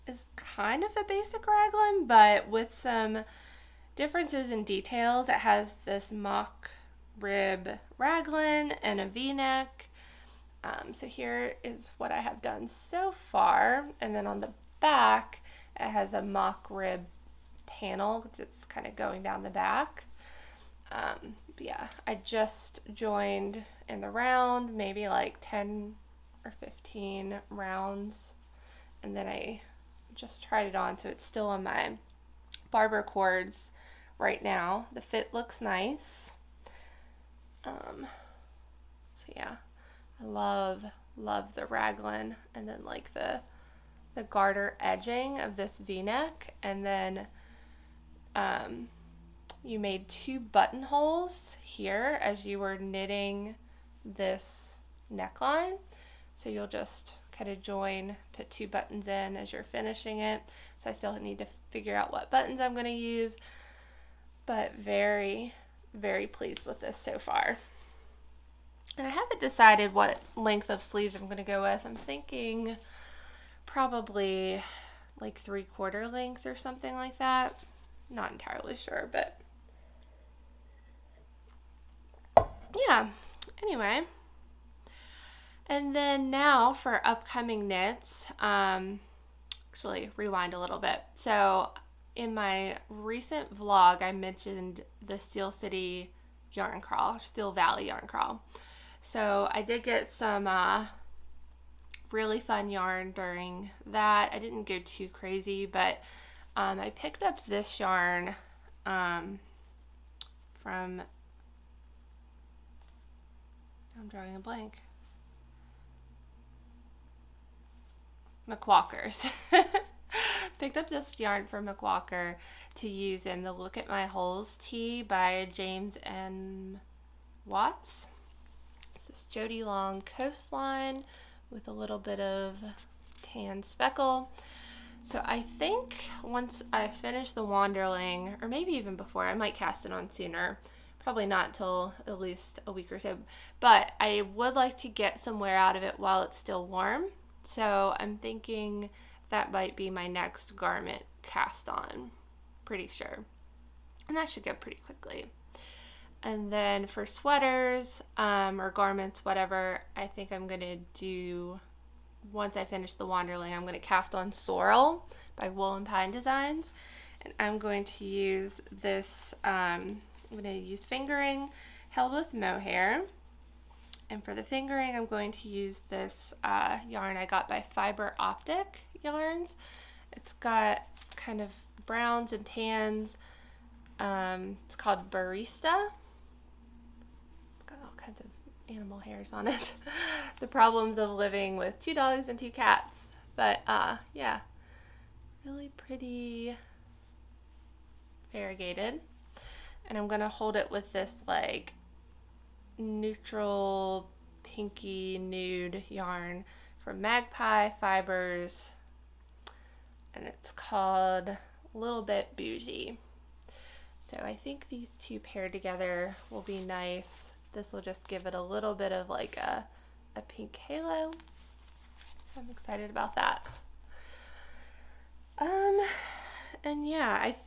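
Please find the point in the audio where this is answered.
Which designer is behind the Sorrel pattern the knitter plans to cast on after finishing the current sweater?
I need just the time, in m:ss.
2:45.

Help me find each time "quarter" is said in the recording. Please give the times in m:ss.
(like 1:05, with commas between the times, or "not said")
1:15.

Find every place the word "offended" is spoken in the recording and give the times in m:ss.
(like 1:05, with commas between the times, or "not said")
not said.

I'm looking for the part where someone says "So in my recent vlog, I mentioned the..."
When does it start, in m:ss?
1:31.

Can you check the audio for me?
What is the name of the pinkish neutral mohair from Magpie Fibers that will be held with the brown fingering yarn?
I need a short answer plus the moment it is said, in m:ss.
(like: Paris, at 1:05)
Little Bit Bougie, at 3:31.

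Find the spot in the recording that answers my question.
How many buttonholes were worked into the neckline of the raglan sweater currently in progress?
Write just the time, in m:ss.
0:50.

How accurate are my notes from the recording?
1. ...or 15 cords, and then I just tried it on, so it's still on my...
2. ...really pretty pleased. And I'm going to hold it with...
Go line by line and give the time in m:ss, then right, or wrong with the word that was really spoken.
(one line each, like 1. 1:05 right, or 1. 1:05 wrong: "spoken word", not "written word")
1. 0:26 wrong: "rounds", not "cords"
2. 3:15 wrong: "variegated", not "pleased".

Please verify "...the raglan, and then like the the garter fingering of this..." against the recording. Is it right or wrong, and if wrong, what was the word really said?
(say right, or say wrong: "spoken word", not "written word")
wrong: "edging", not "fingering".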